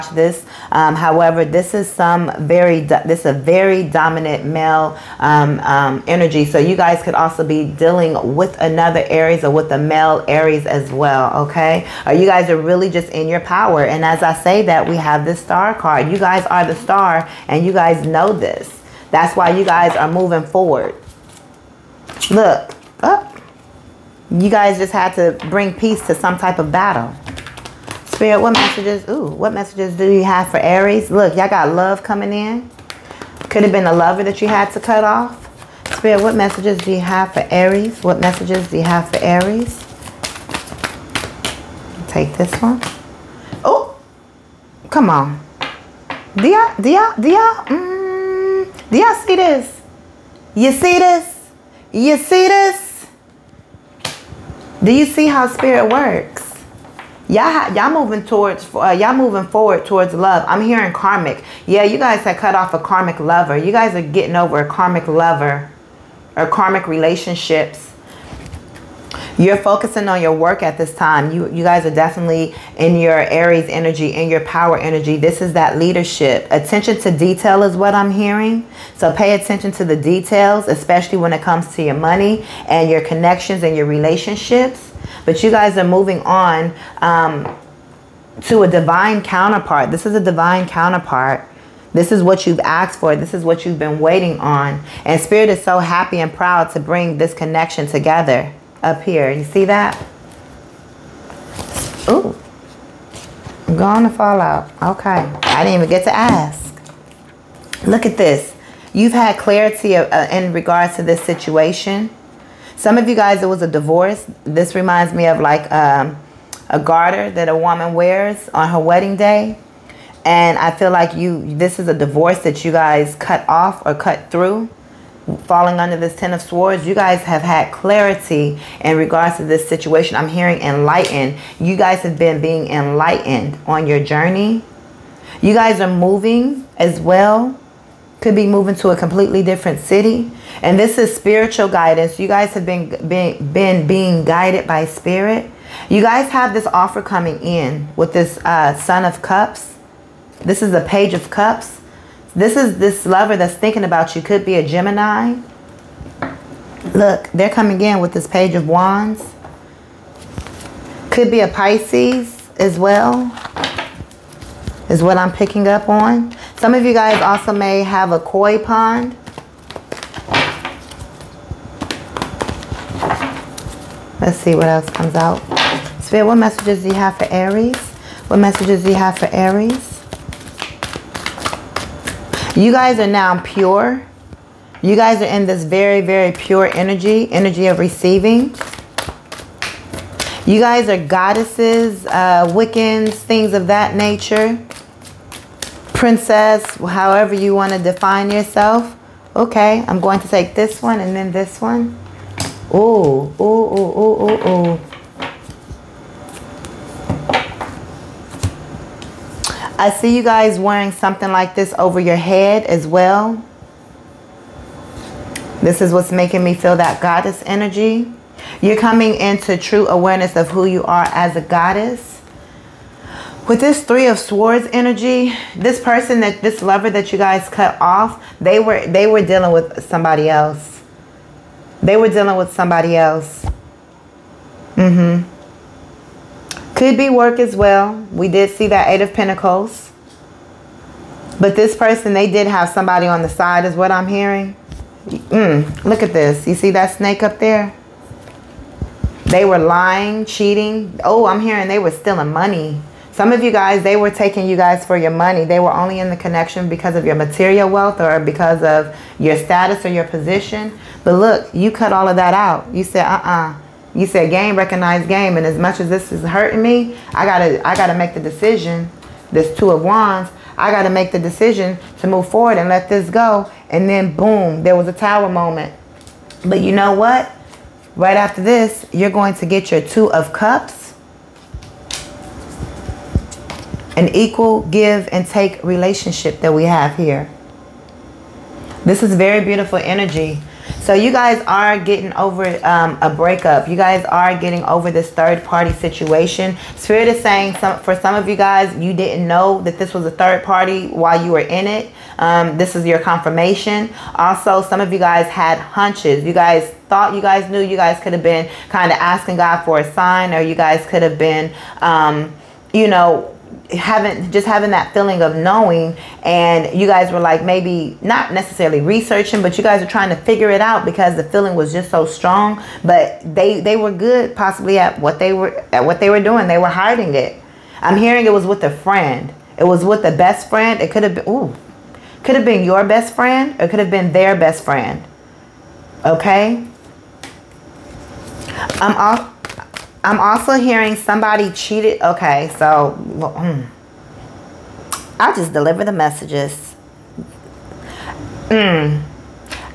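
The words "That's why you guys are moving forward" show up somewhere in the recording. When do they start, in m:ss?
0:19.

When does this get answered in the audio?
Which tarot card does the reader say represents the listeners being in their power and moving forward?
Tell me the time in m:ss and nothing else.
0:15.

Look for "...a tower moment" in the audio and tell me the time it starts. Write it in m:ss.
4:34.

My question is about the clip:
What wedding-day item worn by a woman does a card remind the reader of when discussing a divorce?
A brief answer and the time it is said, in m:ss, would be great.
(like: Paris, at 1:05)
Garter, at 1:56.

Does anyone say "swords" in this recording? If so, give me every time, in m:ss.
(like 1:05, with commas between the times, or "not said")
2:06, 3:44.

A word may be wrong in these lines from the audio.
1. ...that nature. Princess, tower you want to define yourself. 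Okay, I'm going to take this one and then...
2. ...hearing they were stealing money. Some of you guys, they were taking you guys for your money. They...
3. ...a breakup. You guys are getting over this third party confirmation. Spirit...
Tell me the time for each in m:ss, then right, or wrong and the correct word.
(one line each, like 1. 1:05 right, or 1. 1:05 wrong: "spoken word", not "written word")
1. 3:13 wrong: "however", not "tower"
2. 4:11 right
3. 4:53 wrong: "situation", not "confirmation".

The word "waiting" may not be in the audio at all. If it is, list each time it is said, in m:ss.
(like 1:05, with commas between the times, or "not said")
1:33.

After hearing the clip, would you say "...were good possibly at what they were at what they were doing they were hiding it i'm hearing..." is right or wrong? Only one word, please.
right.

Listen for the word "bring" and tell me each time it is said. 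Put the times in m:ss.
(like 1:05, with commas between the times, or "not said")
0:25, 1:36.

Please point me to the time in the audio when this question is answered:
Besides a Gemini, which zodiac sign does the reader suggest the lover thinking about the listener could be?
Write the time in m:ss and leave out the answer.
2:41.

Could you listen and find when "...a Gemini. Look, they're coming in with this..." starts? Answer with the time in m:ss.
2:34.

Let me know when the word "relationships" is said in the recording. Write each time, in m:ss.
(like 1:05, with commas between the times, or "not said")
1:06, 1:23, 4:45.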